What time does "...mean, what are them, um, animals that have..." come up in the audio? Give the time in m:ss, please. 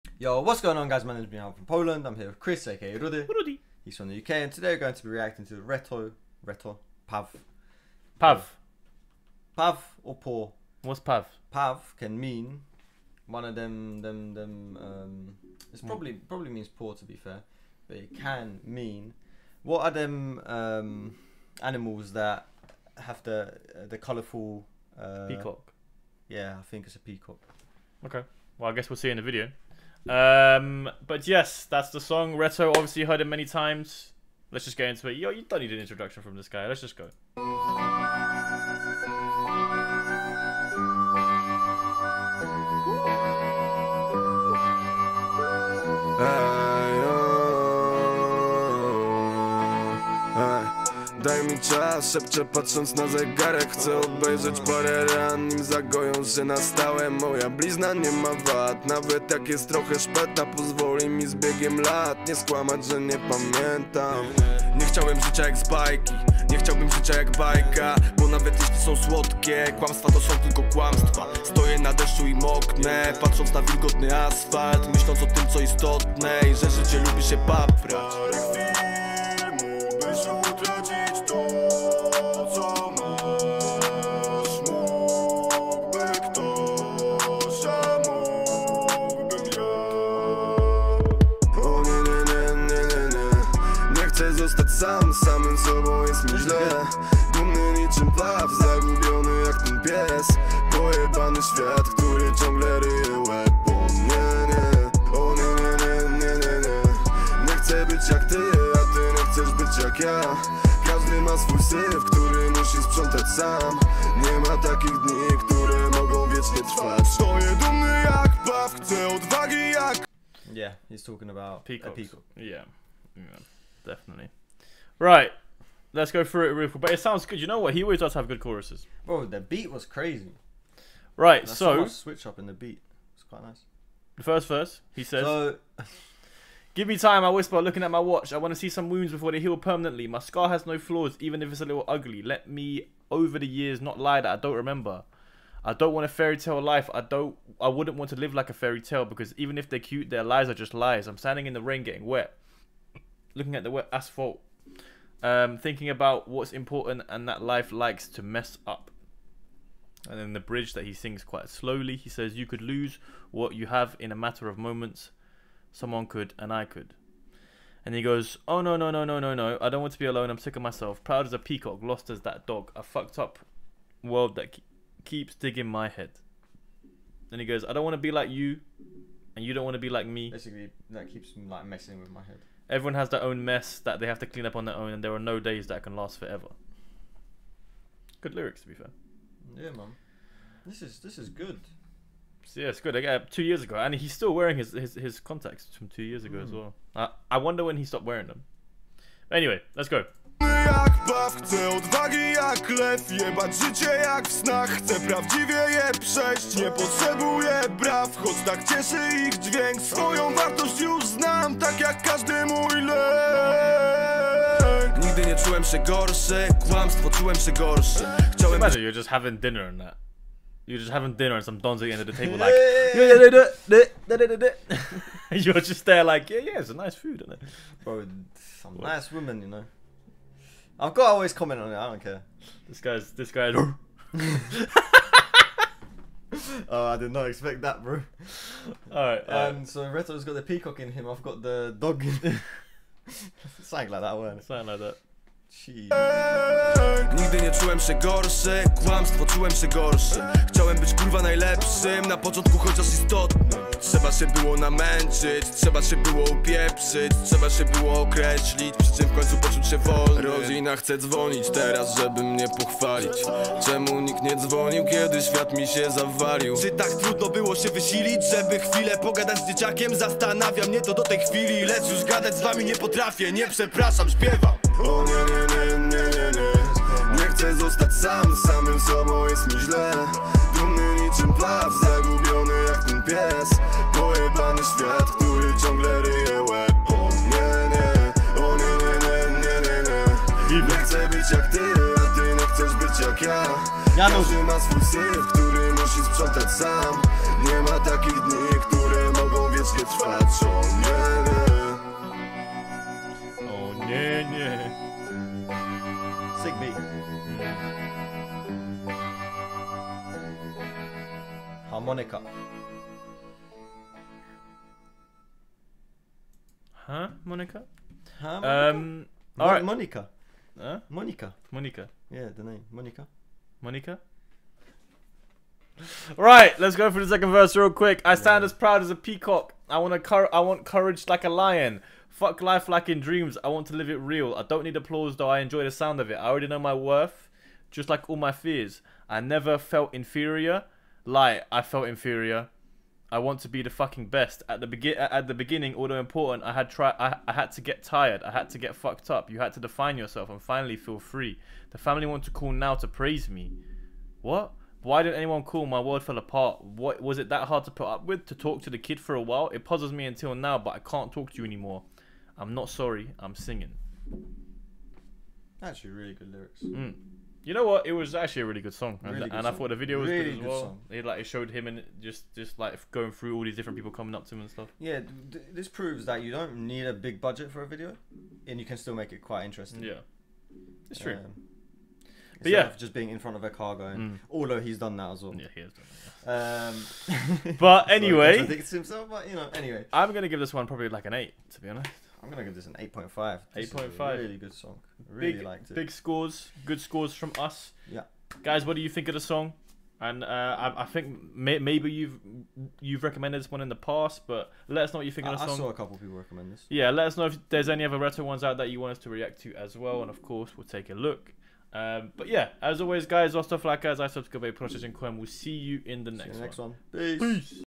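0:18.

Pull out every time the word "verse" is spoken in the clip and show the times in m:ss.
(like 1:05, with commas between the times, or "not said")
2:14, 5:27.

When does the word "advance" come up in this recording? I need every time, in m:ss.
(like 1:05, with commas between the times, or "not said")
not said.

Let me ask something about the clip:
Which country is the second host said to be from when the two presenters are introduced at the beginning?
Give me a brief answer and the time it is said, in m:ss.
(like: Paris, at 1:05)
UK, at 0:04.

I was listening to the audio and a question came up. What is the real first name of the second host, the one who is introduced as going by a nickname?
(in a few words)
Chris.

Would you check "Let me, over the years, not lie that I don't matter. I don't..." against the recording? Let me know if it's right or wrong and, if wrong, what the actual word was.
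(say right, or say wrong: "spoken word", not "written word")
wrong: "remember", not "matter".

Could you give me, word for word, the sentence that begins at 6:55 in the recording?
We'll see you in the next, see you next one.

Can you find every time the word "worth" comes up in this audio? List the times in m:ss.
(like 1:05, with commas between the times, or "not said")
5:36.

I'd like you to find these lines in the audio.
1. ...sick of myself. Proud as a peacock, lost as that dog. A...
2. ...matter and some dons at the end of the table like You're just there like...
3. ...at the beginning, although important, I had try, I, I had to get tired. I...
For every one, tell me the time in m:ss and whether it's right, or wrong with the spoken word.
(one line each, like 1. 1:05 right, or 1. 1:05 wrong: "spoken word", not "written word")
1. 2:50 right
2. 3:41 wrong: "dinner", not "matter"
3. 5:44 right.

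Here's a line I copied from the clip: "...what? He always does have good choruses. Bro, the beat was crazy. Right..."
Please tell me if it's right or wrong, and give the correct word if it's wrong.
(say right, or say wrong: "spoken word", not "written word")
right.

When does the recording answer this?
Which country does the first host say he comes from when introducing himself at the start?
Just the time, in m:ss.
0:01.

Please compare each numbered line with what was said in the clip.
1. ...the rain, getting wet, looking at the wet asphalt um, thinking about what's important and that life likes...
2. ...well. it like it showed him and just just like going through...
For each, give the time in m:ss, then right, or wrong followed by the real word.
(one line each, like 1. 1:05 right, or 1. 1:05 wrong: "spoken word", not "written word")
1. 2:31 right
2. 6:10 right.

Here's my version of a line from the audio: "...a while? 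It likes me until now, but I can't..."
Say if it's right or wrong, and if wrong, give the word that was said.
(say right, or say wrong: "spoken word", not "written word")
wrong: "puzzles", not "likes".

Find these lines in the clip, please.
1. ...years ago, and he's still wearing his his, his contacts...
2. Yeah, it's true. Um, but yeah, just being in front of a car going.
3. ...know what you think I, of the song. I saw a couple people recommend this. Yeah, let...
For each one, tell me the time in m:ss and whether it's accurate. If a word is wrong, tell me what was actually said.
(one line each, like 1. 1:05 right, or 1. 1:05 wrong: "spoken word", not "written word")
1. 3:13 right
2. 6:19 right
3. 6:44 right.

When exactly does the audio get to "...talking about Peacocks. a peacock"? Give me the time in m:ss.
2:01.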